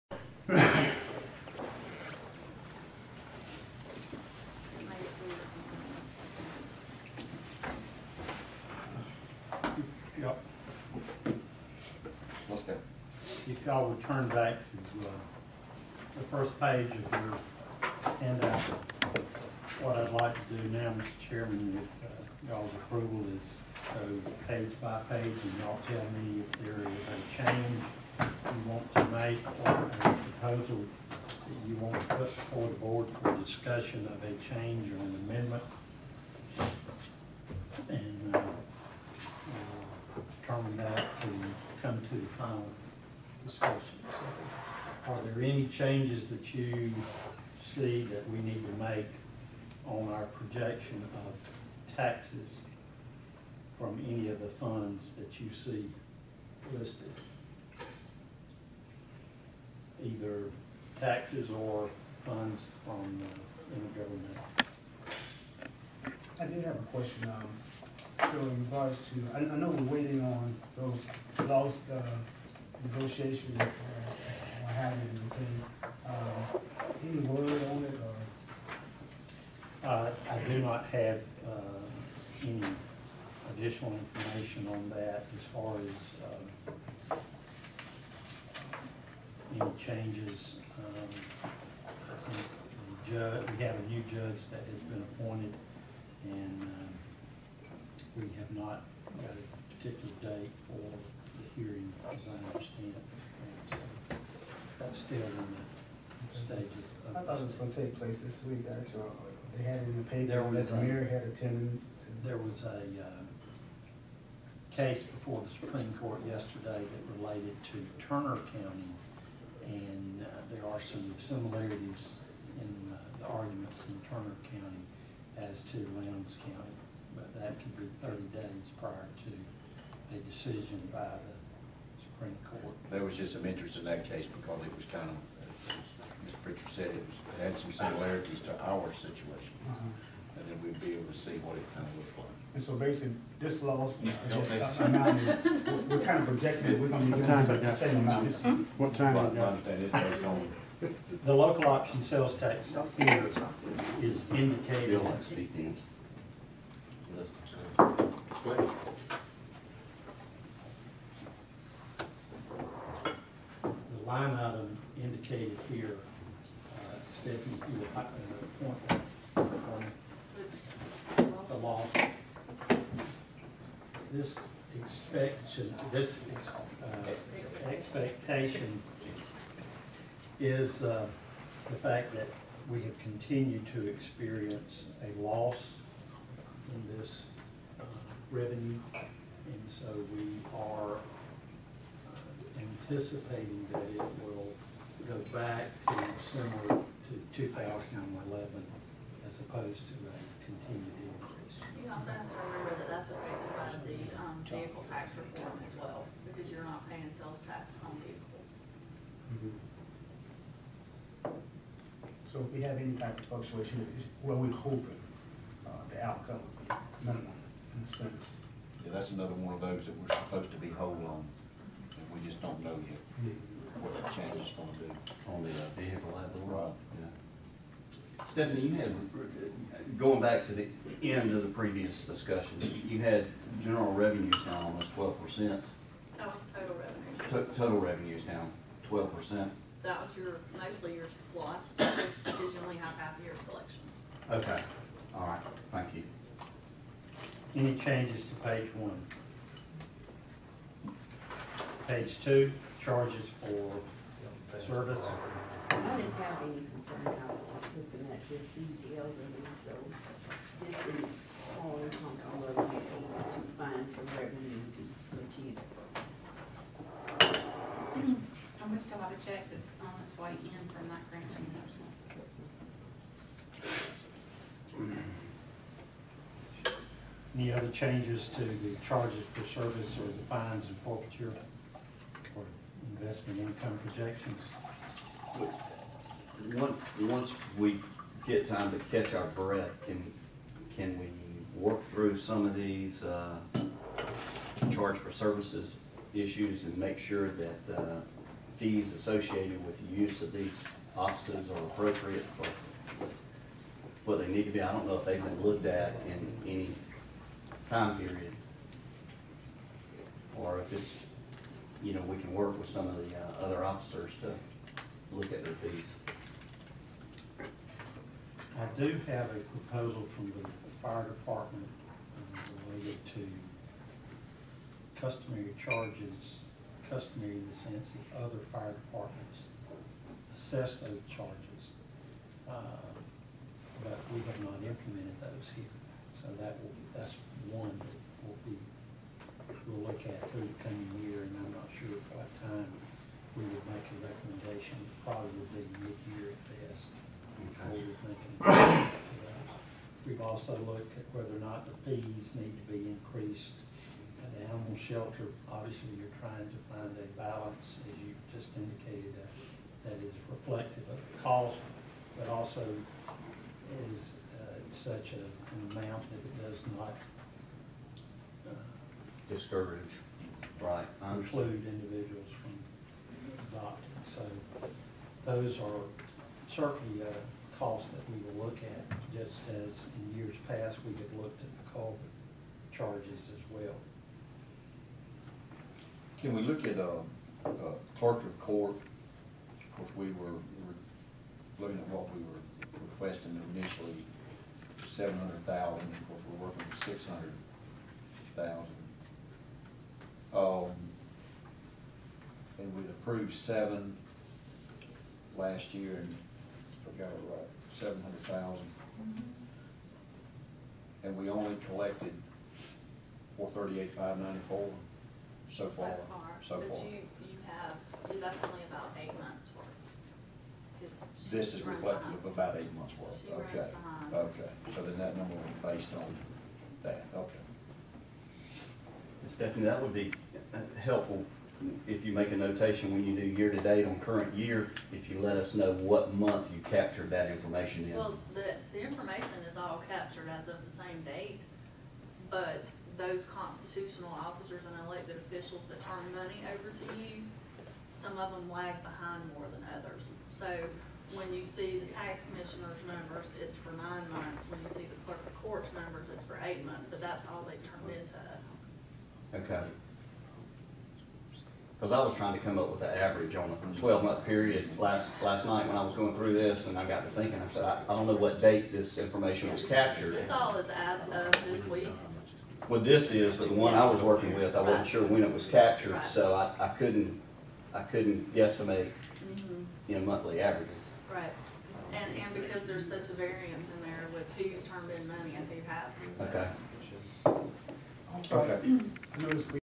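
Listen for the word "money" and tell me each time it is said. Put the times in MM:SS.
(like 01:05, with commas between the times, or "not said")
07:26, 08:05.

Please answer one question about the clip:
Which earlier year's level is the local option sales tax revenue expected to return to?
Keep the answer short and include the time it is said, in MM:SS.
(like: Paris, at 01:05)
2011, at 03:17.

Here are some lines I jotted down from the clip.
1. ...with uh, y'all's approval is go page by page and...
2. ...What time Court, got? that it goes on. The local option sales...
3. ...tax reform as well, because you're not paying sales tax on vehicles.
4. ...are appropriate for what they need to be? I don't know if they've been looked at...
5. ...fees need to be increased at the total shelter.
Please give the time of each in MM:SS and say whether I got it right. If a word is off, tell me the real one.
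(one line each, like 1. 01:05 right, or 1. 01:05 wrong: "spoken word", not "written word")
1. 00:21 right
2. 02:28 wrong: "But", not "Court"
3. 03:24 right
4. 05:01 right
5. 05:51 wrong: "animal", not "total".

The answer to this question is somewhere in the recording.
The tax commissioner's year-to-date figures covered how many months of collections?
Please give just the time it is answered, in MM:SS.
07:33.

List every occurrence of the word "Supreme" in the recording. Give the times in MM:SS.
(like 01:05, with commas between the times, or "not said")
01:55, 02:12.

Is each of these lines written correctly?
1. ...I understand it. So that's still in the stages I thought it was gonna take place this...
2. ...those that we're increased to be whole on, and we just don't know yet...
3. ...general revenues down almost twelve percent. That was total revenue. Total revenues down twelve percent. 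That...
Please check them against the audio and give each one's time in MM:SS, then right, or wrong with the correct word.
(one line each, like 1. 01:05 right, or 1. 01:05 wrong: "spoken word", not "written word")
1. 01:42 right
2. 03:39 wrong: "supposed", not "increased"
3. 03:53 right.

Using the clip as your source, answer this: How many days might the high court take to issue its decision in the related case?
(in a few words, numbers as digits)
30.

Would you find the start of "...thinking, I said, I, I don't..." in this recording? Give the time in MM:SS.
07:47.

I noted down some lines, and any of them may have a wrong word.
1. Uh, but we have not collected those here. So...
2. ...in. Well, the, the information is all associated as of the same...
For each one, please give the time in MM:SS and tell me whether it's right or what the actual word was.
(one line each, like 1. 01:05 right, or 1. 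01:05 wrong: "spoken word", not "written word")
1. 05:32 wrong: "implemented", not "collected"
2. 07:17 wrong: "captured", not "associated".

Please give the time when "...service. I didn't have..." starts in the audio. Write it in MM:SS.
04:14.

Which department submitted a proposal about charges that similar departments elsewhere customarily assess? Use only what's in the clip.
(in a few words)
fire department.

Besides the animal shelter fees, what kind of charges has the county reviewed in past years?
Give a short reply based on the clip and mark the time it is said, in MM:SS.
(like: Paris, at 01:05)
culvert charges, at 06:21.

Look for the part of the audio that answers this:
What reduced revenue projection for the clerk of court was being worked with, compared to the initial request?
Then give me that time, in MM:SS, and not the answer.
06:36.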